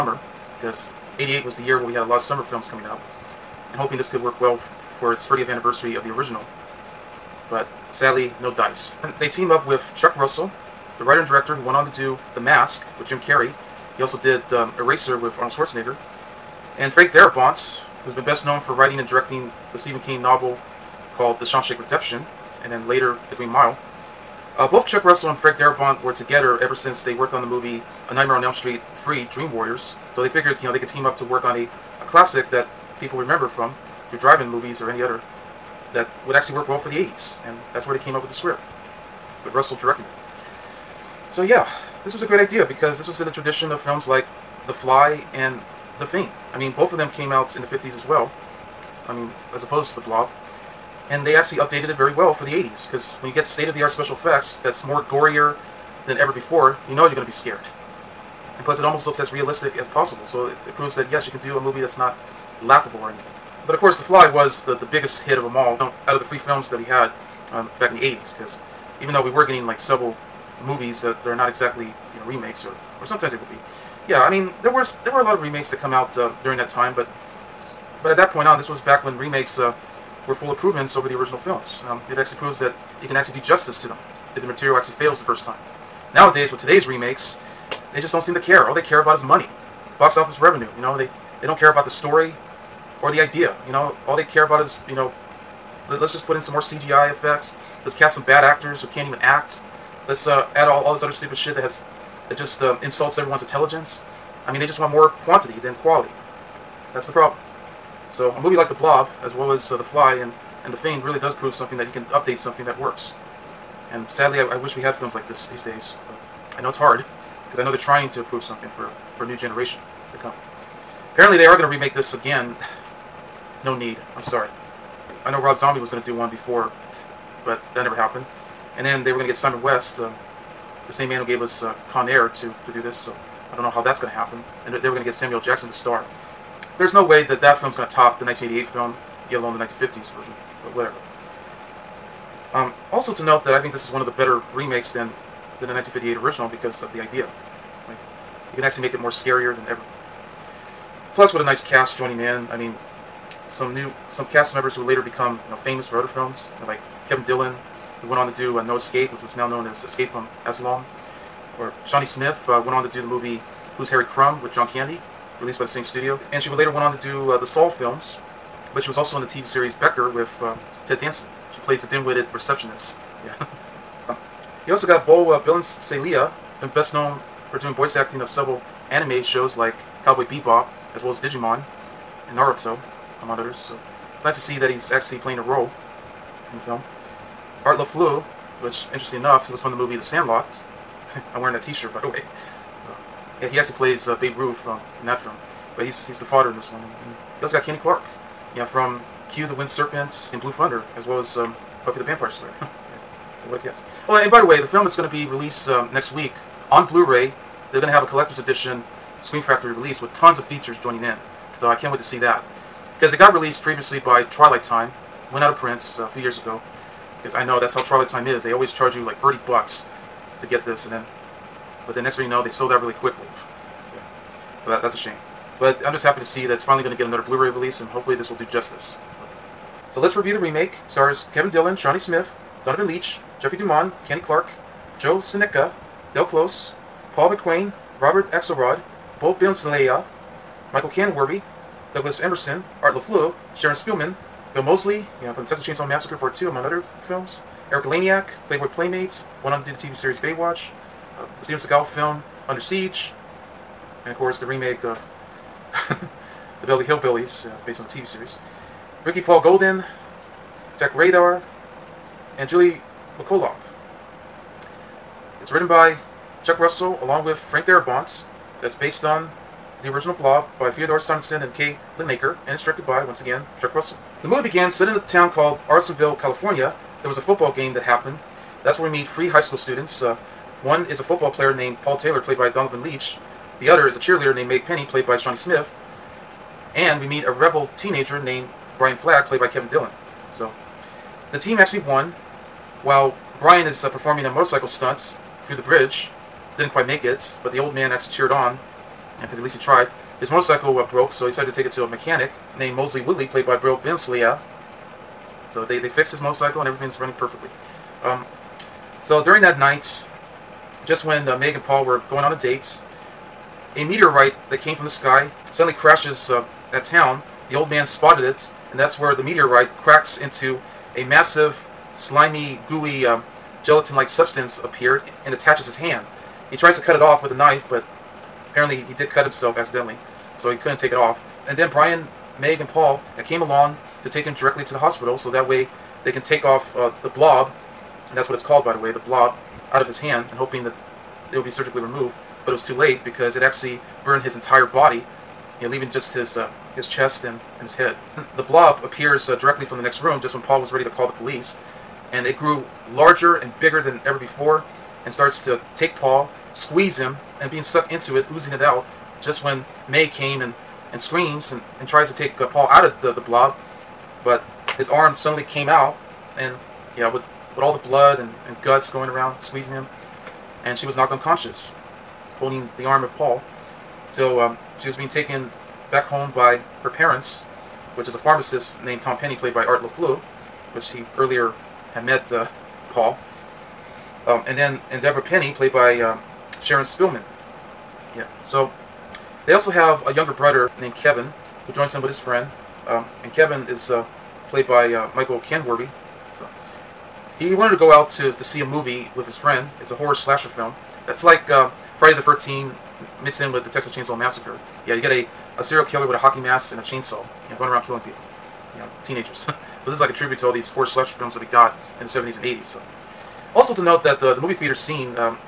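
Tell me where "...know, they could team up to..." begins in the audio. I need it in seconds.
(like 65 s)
30 s.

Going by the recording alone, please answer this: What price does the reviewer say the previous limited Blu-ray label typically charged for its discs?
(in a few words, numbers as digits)
30 bucks.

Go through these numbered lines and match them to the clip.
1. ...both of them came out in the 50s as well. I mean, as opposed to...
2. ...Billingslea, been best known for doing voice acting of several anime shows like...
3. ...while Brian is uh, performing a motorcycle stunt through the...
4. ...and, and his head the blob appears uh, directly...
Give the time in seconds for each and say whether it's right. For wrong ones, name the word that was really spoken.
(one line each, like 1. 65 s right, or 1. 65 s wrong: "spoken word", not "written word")
1. 46 s right
2. 175 s right
3. 292 s right
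4. 347 s right.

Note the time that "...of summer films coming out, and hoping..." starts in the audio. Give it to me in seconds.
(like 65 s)
2 s.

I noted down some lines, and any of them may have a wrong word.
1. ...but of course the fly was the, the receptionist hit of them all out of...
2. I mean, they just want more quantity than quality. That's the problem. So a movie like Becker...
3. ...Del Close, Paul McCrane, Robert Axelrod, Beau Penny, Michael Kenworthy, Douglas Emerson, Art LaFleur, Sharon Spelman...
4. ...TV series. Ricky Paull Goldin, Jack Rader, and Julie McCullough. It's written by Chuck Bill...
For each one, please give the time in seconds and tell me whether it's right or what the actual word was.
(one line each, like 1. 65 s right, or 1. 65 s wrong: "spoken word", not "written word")
1. 63 s wrong: "biggest", not "receptionist"
2. 104 s wrong: "The", not "Becker"
3. 236 s wrong: "Billingslea", not "Penny"
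4. 257 s wrong: "Russell", not "Bill".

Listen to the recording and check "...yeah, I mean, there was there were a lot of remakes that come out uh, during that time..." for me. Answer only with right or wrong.
right.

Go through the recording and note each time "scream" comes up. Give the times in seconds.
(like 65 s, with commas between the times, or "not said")
209 s, 360 s.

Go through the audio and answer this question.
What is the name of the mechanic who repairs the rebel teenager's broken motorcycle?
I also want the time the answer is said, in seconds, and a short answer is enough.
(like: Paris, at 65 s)
Mosley Woodley, at 302 s.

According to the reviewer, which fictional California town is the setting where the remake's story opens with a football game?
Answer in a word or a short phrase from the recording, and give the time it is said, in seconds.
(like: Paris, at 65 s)
Arlingtonville, at 275 s.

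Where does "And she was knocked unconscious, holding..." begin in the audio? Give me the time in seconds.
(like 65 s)
370 s.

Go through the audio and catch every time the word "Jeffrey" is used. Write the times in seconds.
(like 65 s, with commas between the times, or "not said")
233 s.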